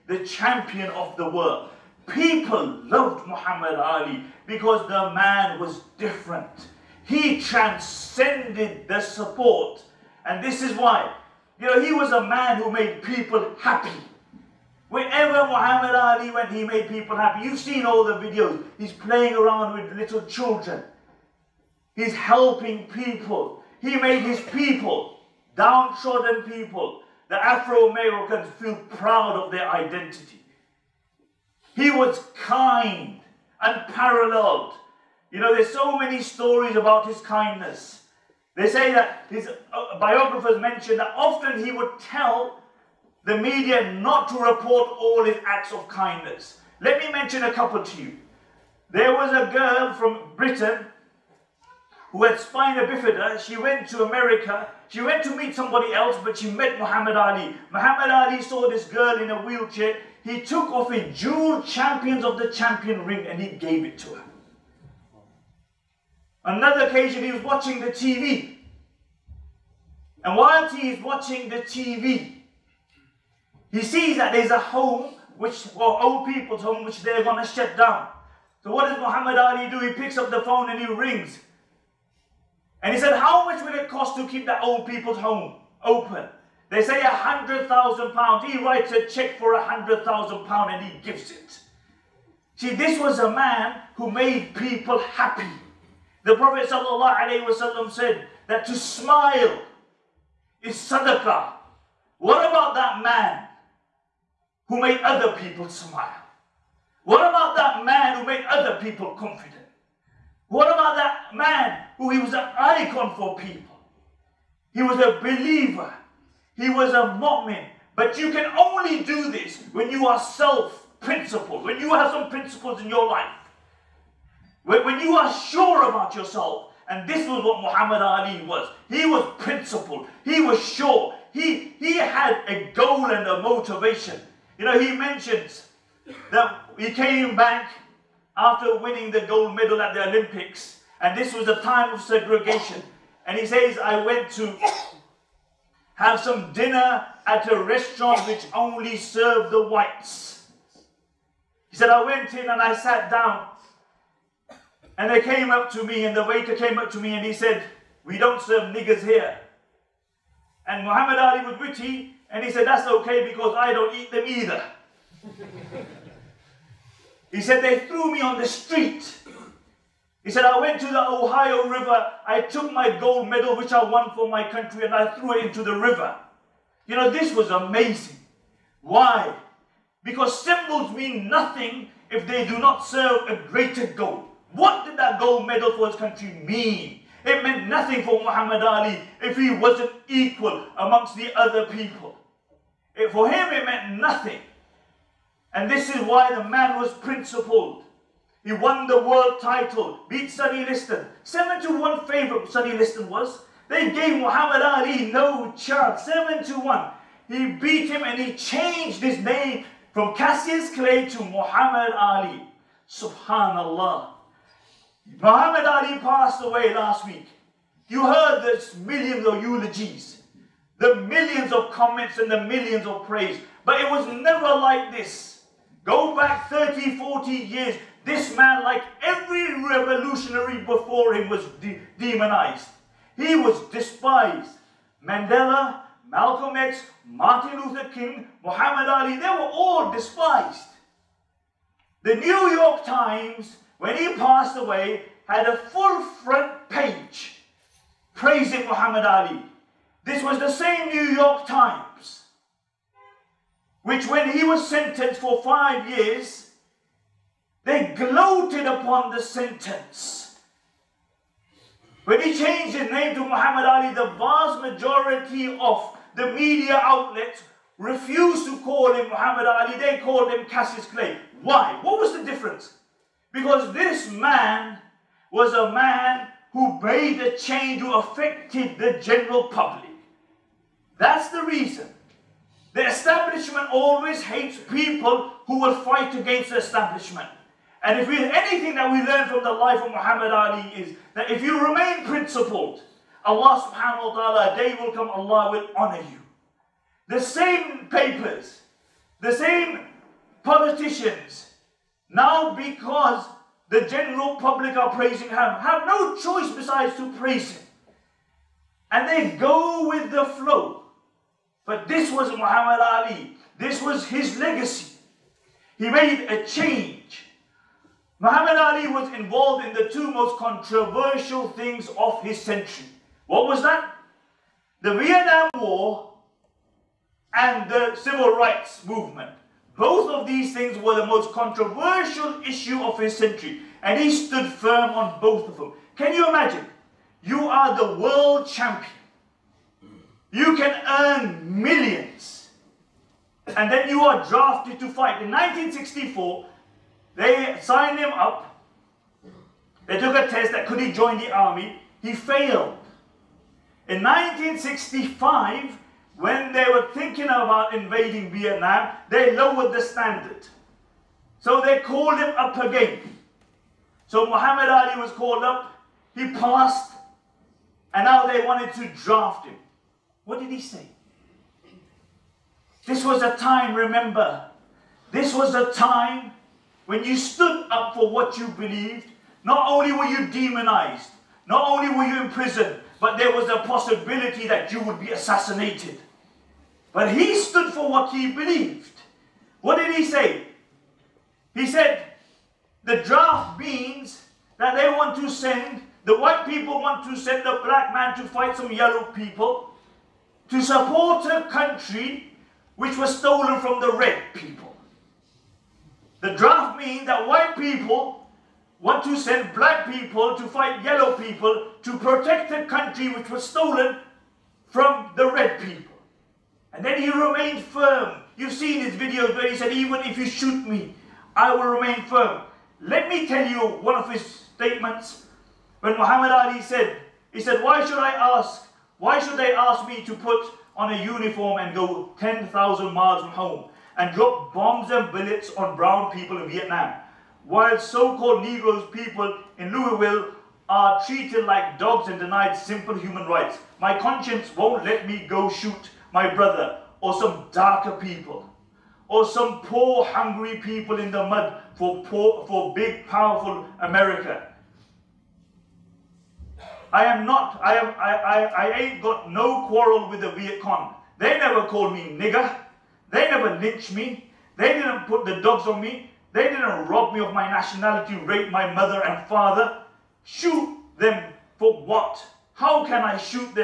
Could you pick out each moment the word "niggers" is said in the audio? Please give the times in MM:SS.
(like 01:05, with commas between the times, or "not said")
02:38, 07:42.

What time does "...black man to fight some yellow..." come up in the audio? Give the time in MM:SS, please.
06:37.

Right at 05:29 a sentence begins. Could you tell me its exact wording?
Both of these things were the most controversial issue of his century, and he stood firm on both of them.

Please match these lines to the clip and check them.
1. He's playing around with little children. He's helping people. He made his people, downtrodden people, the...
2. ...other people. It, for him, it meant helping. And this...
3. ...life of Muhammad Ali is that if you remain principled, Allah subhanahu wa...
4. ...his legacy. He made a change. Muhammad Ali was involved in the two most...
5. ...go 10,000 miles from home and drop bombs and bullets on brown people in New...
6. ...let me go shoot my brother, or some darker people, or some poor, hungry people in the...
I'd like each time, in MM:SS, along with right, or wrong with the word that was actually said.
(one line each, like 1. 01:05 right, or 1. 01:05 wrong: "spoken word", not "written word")
1. 00:18 right
2. 03:11 wrong: "nothing", not "helping"
3. 04:49 right
4. 05:14 right
5. 07:11 wrong: "Vietnam", not "New"
6. 07:24 right.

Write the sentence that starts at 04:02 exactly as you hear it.
The New York Times when he passed away, had a full front page praising Muhammad Ali.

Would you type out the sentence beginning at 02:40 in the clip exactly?
And Muhammad Ali was witty, and he said, That's okay because I don't eat them either.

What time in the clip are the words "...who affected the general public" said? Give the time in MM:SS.
04:37.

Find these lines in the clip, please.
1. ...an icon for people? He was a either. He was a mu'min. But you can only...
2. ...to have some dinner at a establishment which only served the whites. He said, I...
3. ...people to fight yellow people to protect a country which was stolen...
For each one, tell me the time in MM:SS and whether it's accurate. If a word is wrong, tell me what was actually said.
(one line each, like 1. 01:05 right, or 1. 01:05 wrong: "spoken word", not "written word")
1. 01:52 wrong: "believer", not "either"
2. 02:24 wrong: "restaurant", not "establishment"
3. 06:49 right.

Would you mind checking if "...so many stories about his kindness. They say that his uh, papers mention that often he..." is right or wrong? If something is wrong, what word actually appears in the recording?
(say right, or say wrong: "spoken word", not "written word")
wrong: "biographers", not "papers".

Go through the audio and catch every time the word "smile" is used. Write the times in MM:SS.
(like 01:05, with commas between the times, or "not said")
01:38, 01:45.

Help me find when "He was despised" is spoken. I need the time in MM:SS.
03:53.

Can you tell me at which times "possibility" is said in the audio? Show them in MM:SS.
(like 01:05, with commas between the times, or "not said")
06:23.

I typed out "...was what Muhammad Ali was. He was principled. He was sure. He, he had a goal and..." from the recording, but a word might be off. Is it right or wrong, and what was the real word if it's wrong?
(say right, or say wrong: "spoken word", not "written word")
right.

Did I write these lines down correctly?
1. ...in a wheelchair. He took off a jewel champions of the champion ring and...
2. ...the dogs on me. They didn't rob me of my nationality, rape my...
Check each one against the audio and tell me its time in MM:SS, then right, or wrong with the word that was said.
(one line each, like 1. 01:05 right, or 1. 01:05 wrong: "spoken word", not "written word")
1. 00:59 right
2. 07:45 right.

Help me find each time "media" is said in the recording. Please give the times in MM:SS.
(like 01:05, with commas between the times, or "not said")
00:43, 04:26.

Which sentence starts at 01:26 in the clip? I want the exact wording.
They say a hundred thousand pounds.